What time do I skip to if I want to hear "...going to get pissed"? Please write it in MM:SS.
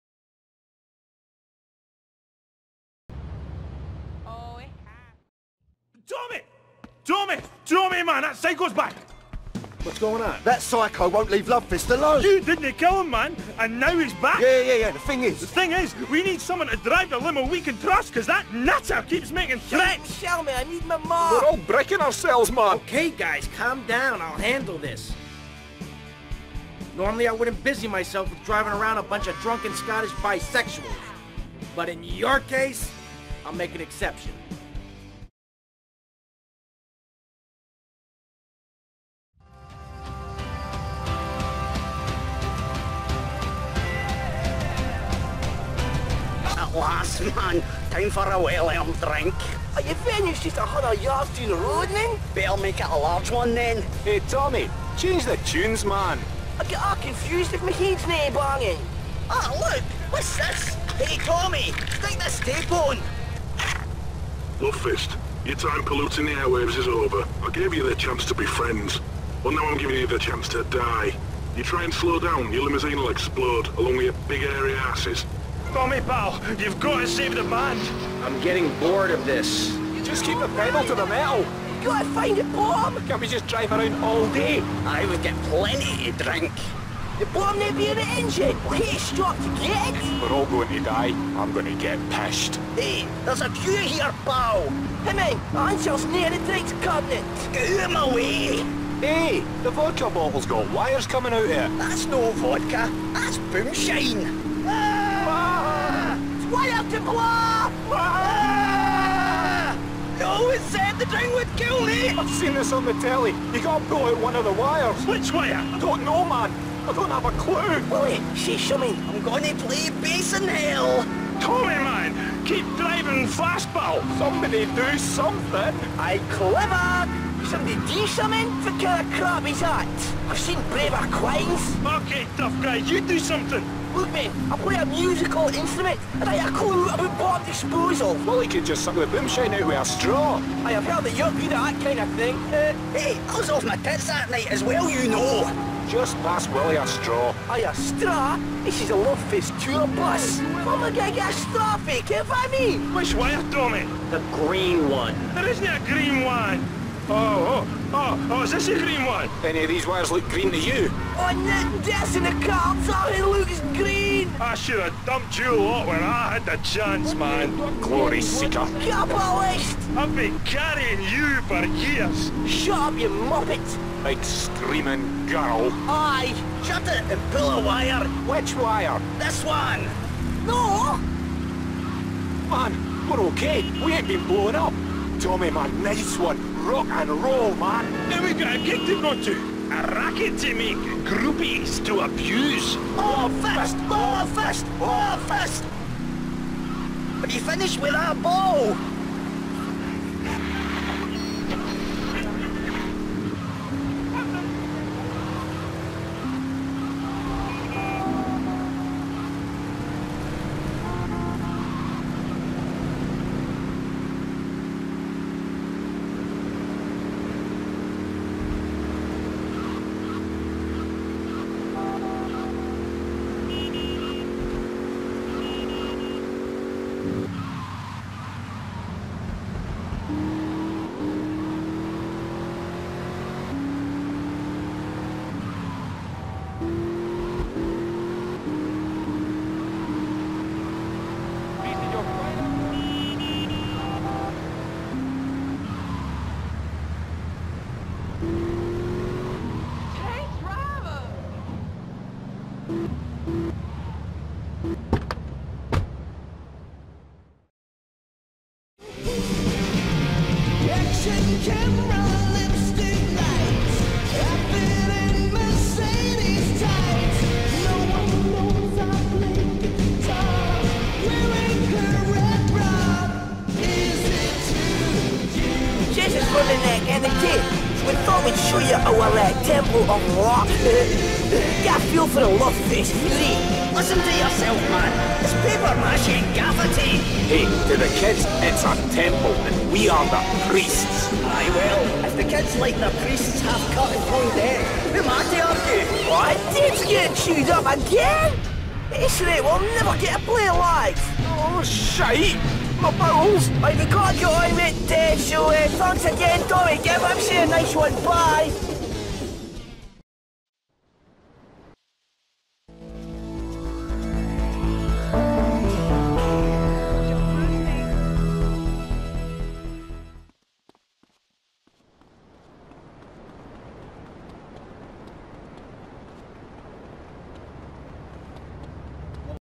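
01:31.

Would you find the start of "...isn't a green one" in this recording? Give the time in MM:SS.
02:35.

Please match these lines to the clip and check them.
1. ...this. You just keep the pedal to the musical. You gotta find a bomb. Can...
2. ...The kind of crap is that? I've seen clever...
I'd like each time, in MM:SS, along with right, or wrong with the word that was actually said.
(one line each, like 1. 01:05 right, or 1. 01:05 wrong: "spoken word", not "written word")
1. 01:19 wrong: "metal", not "musical"
2. 02:08 wrong: "braver", not "clever".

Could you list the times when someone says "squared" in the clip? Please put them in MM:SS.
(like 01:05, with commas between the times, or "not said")
not said.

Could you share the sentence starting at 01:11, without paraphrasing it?
You try and slow down, your limousine will explode, along with your big airy asses.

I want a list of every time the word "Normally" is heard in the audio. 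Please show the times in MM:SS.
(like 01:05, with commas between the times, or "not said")
00:26.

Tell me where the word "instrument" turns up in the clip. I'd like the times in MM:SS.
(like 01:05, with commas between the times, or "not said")
02:15.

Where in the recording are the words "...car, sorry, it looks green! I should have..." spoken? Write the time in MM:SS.
02:42.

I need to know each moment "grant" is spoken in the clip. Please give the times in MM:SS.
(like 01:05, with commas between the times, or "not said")
not said.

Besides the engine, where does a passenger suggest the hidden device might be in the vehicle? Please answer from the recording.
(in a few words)
Near the drinks cabinet.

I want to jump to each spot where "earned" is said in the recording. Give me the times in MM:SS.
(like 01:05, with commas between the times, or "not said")
00:48.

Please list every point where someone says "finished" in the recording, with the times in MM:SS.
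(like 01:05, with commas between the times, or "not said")
00:49, 03:17.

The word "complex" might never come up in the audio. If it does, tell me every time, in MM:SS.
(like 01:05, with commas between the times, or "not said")
not said.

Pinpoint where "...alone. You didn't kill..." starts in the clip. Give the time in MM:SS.
00:11.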